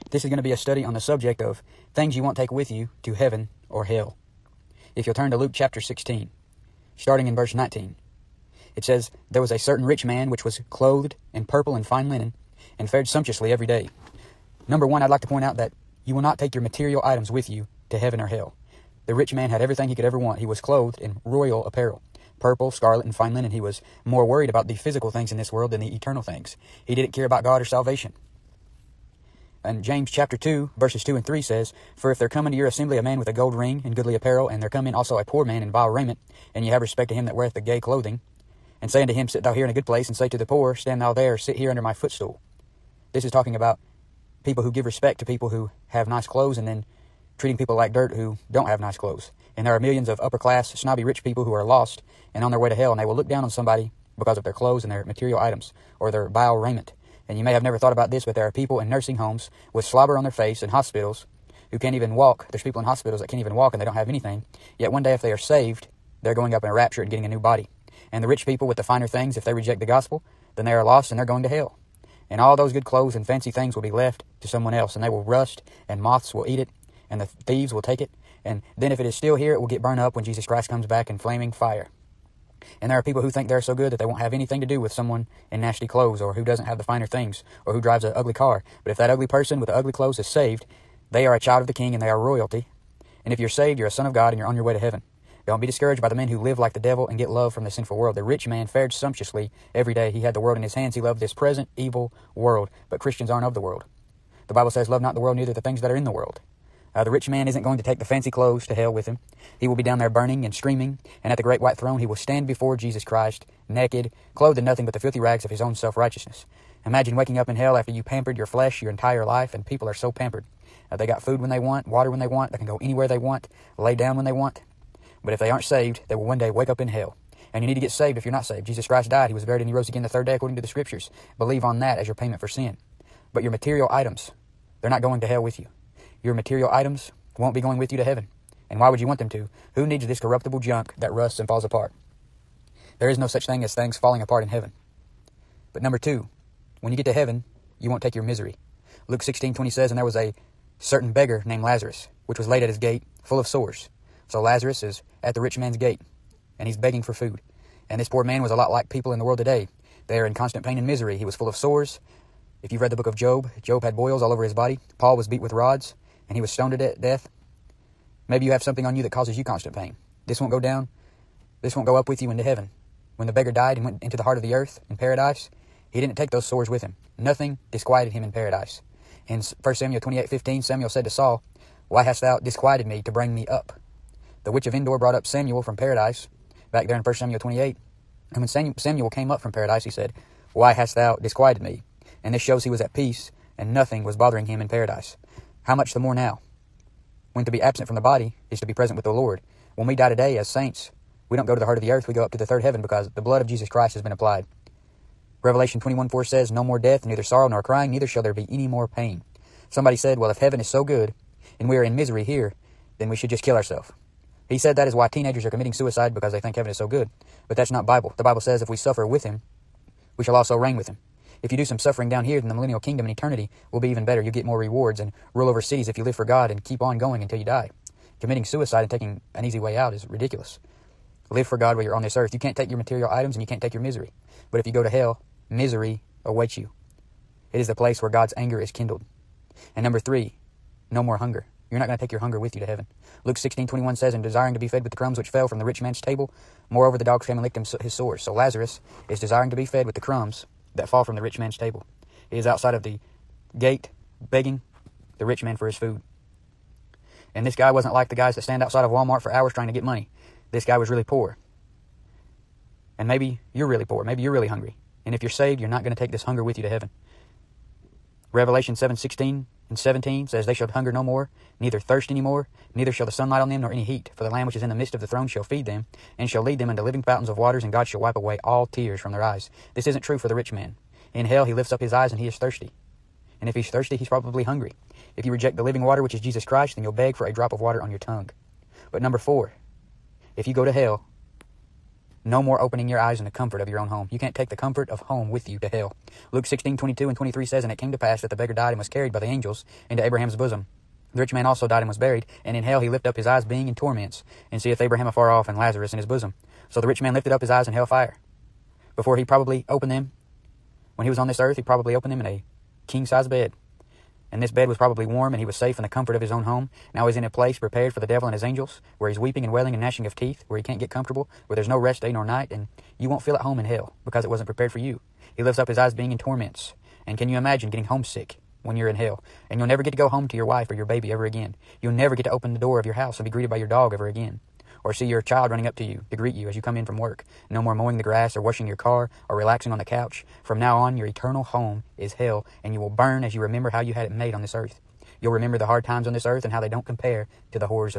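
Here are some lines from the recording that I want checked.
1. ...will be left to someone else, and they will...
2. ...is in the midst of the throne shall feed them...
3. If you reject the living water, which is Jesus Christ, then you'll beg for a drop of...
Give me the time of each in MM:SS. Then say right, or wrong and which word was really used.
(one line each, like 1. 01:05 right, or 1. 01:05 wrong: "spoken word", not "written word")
1. 01:13 right
2. 04:34 right
3. 04:45 right.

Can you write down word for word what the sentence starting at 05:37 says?
No more mowing the grass or washing your car or relaxing on the couch.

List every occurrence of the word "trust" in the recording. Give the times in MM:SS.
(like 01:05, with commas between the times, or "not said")
not said.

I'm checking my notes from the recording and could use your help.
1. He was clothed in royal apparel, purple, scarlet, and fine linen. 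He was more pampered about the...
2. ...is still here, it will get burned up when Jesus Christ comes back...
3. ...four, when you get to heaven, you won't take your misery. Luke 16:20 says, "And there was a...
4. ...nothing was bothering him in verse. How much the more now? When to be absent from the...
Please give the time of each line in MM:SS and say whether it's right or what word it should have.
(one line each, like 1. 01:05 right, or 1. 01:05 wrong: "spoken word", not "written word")
1. 00:20 wrong: "worried", not "pampered"
2. 01:19 right
3. 02:25 wrong: "two", not "four"
4. 03:13 wrong: "paradise", not "verse".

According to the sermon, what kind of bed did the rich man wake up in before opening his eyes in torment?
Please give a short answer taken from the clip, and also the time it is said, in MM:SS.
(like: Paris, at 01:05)
king size bed, at 05:12.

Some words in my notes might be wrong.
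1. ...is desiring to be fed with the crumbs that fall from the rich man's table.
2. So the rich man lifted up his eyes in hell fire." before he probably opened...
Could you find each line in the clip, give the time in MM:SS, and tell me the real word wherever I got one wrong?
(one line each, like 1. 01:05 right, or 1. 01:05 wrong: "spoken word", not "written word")
1. 04:09 right
2. 05:06 right.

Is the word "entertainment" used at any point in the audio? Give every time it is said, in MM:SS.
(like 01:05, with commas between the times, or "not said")
not said.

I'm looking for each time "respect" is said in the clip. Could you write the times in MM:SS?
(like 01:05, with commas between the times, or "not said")
00:36, 00:44.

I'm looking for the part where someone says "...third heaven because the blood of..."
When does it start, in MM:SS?
03:22.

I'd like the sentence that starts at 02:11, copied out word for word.
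Believe on that as your payment for sin.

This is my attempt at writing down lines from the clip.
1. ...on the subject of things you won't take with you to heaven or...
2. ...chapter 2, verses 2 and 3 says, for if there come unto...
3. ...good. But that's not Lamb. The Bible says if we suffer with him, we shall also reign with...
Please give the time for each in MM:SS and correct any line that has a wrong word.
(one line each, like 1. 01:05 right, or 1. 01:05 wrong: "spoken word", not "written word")
1. 00:00 right
2. 00:30 right
3. 03:36 wrong: "Bible", not "Lamb".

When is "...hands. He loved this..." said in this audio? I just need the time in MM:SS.
01:40.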